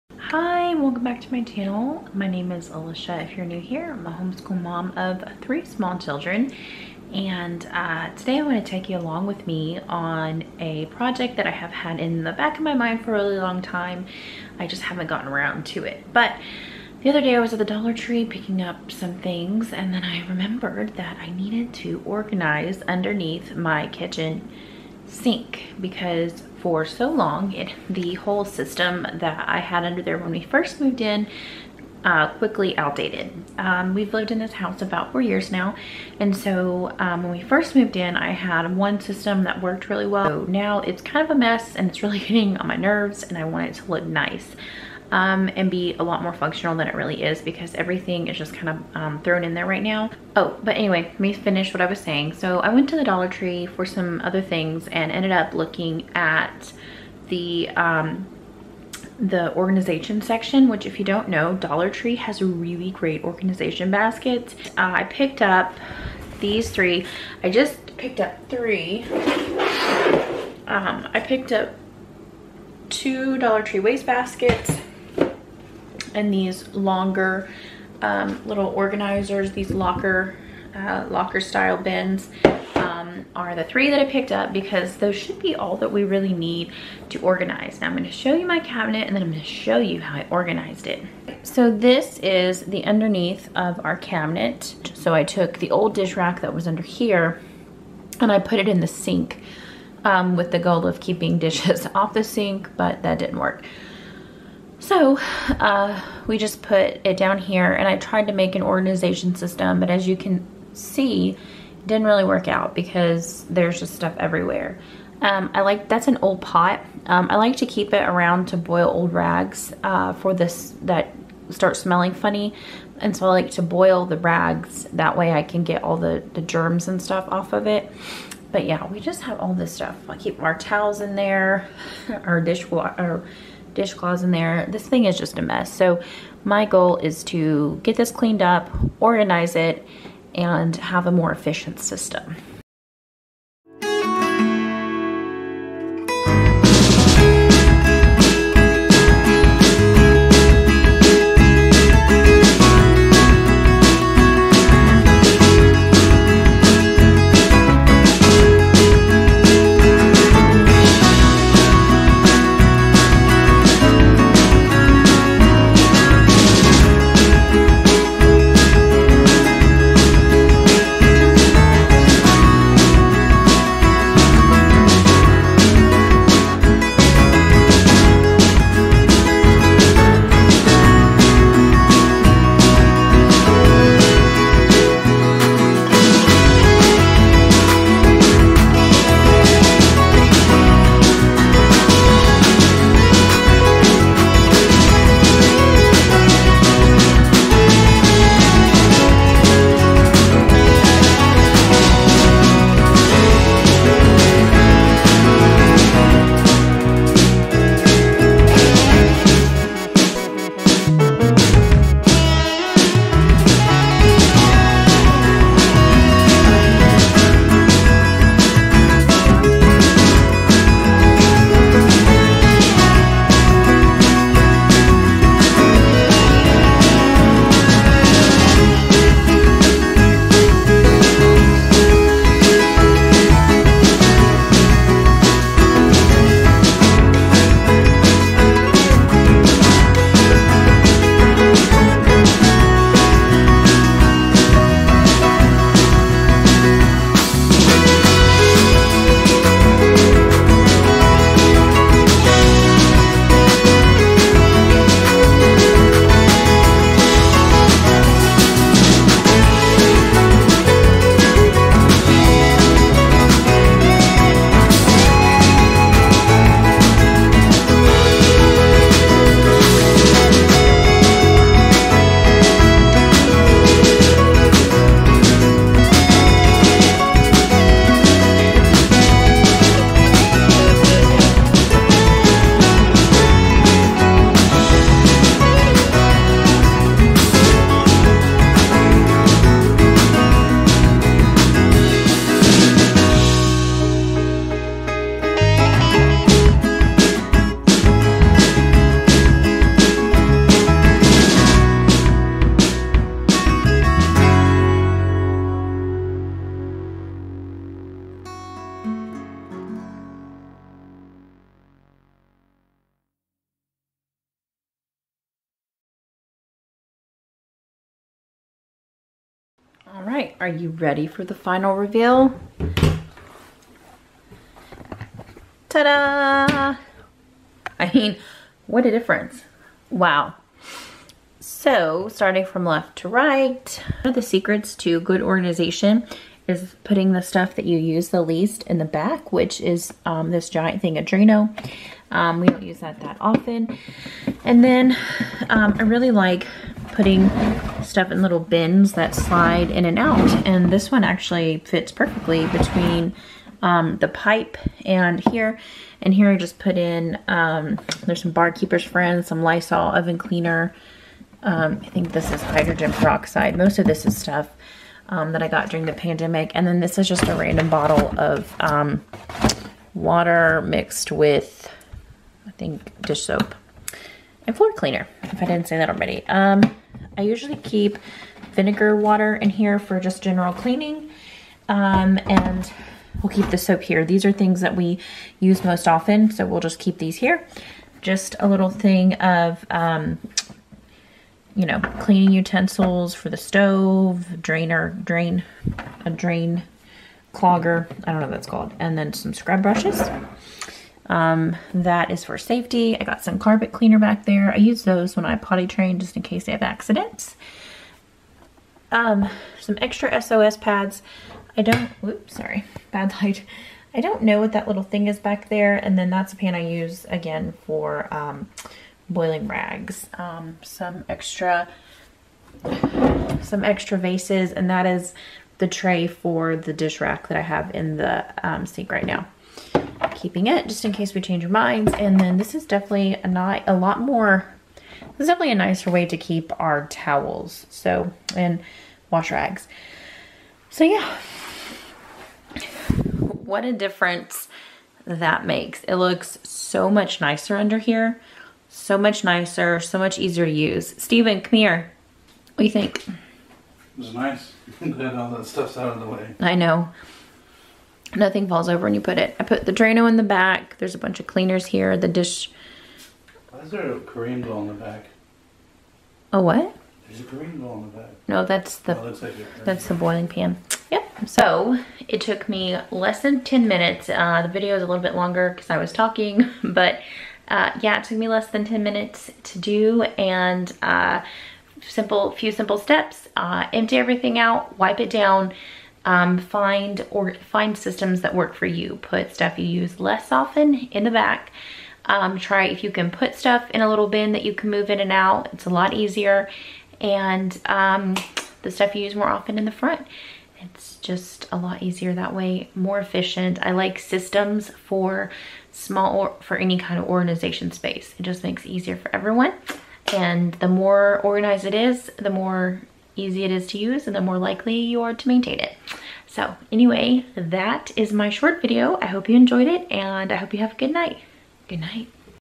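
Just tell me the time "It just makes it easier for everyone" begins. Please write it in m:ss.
8:28.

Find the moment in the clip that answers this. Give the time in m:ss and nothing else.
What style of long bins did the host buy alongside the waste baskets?
1:21.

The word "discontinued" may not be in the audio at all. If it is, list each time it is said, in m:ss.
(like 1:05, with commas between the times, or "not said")
not said.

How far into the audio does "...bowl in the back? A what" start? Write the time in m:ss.
7:44.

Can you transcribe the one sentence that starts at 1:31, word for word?
So this is the underneath of our cabinet.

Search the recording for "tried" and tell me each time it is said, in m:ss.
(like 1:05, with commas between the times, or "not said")
1:47.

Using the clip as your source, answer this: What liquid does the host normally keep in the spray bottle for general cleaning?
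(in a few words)
Vinegar water.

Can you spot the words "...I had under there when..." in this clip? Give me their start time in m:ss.
0:29.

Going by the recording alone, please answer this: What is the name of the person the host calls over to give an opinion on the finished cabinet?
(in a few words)
Steven.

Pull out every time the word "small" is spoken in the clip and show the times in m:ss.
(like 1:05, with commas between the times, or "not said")
0:05, 8:25.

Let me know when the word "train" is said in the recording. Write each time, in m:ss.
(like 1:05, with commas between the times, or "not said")
6:45.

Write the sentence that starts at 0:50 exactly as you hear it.
Oh, but anyway, let me finish what I was saying.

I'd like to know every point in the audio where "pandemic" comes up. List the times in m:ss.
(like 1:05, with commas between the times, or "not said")
6:05.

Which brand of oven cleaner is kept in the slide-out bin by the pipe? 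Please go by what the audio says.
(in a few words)
Lysol.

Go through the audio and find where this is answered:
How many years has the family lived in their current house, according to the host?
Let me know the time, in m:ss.
0:35.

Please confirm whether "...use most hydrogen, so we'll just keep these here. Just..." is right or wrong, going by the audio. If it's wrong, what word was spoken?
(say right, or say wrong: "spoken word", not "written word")
wrong: "often", not "hydrogen".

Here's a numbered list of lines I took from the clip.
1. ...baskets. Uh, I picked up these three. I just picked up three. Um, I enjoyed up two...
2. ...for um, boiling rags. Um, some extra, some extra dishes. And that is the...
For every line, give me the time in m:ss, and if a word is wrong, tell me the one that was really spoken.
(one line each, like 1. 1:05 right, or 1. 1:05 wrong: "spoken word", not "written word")
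1. 1:03 wrong: "picked", not "enjoyed"
2. 6:57 wrong: "vases", not "dishes".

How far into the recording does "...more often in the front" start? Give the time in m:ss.
8:19.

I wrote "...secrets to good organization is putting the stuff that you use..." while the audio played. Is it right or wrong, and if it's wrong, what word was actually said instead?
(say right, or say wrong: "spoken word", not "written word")
right.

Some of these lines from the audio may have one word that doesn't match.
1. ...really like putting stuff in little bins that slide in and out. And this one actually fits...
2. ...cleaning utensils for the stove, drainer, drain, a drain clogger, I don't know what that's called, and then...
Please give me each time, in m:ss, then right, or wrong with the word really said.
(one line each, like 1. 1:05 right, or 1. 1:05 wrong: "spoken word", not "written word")
1. 5:45 right
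2. 6:31 right.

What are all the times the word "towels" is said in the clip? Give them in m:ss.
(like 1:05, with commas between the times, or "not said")
2:10, 7:16.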